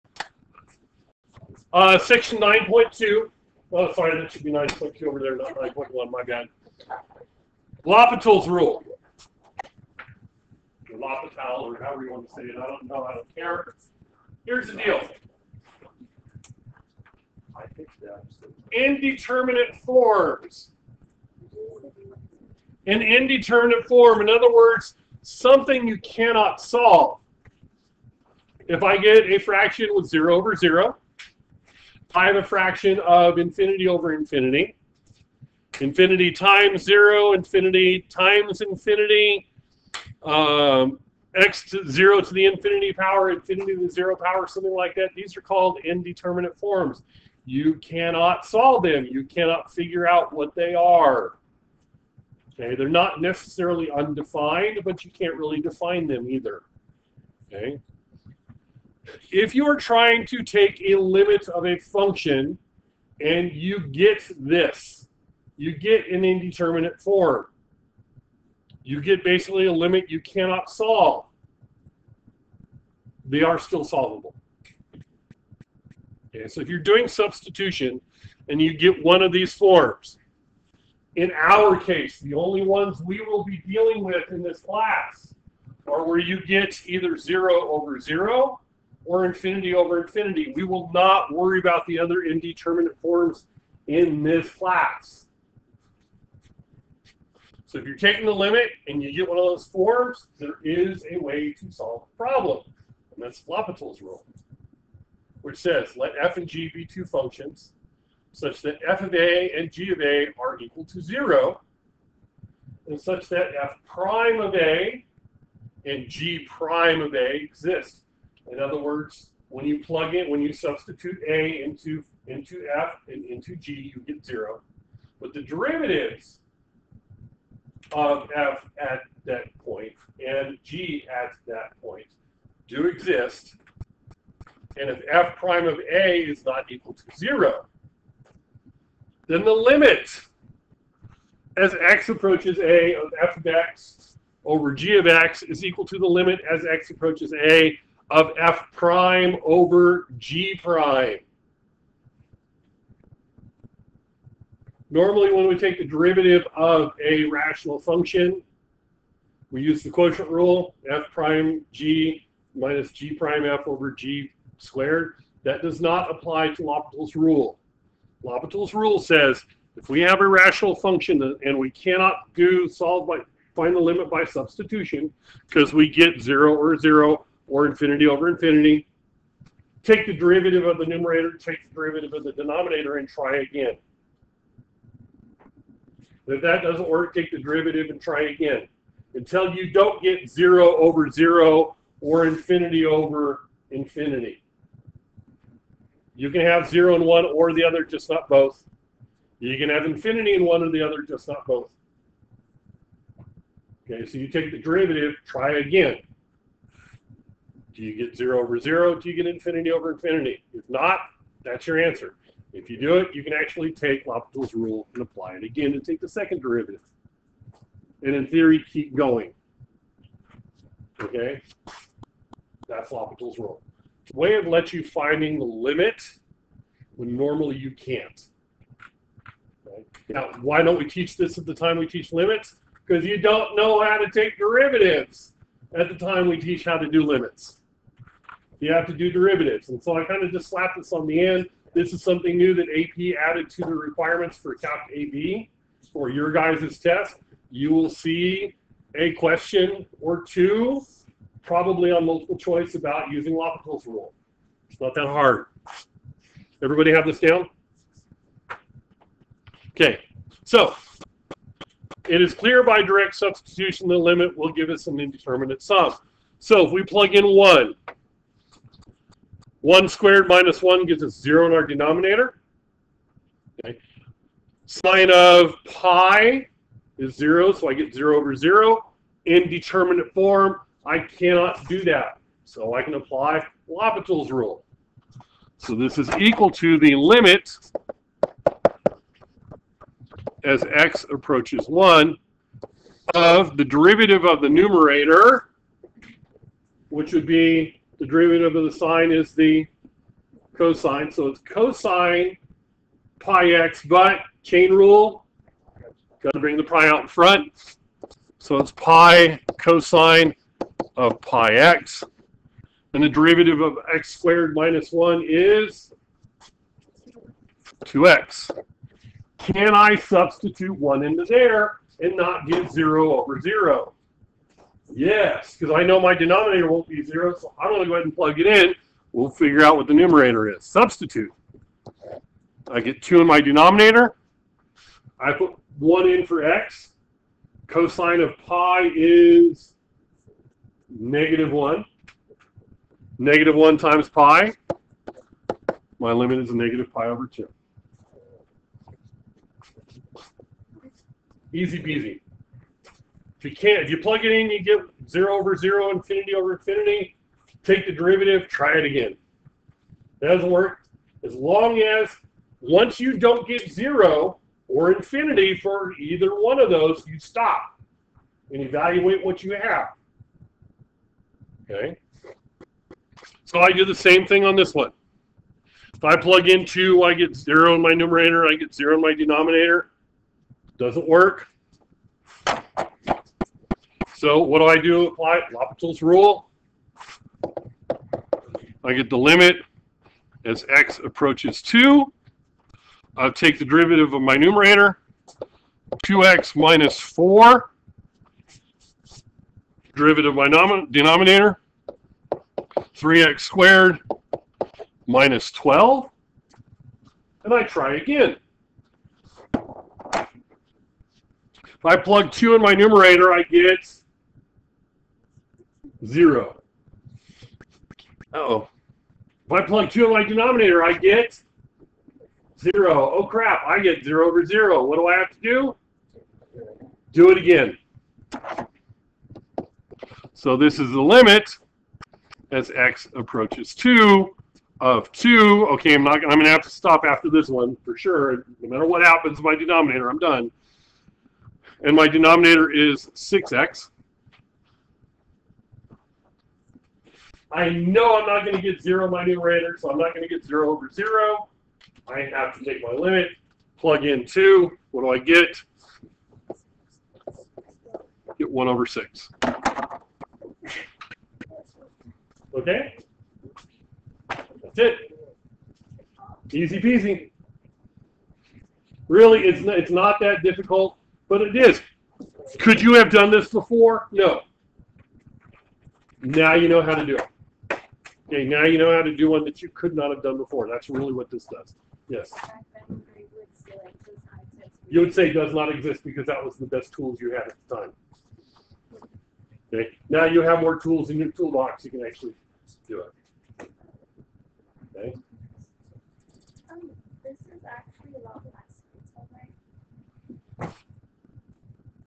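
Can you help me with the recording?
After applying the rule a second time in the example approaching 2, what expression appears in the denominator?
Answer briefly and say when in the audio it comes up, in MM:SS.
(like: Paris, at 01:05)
6x, at 07:23.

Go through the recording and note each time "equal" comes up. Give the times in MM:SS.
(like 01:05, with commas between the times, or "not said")
01:50, 02:16, 02:25, 04:46.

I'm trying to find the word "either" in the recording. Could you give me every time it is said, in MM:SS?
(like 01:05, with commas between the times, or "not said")
00:56, 01:26, 06:05.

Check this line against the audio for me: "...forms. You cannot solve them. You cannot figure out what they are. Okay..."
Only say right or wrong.
right.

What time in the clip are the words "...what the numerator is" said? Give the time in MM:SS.
05:29.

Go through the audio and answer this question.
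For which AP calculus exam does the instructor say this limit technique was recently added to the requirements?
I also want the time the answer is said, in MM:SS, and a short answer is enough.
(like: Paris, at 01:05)
Calc AB, at 04:04.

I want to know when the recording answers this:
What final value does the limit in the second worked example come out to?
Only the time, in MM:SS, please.
07:38.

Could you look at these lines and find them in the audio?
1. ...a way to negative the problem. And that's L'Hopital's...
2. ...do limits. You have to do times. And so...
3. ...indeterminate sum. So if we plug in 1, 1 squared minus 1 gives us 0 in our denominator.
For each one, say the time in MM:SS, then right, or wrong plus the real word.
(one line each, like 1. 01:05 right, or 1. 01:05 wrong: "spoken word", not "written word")
1. 01:41 wrong: "solve", not "negative"
2. 03:56 wrong: "derivatives", not "times"
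3. 04:24 right.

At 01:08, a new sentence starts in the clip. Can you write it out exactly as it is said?
You get basically a limit you cannot solve.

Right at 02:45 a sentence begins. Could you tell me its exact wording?
That does not apply to L'Hopital's rule.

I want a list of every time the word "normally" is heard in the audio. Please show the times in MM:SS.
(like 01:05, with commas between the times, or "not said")
02:34, 03:47.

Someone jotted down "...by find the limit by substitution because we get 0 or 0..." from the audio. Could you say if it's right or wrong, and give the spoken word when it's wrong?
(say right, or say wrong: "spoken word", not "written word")
right.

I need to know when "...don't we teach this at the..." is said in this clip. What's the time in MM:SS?
03:50.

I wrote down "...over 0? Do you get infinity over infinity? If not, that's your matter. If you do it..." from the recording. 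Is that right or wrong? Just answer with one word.
wrong.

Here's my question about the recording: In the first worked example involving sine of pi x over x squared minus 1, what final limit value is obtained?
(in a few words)
-pi/2.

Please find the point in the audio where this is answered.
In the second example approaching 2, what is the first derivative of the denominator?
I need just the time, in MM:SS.
06:42.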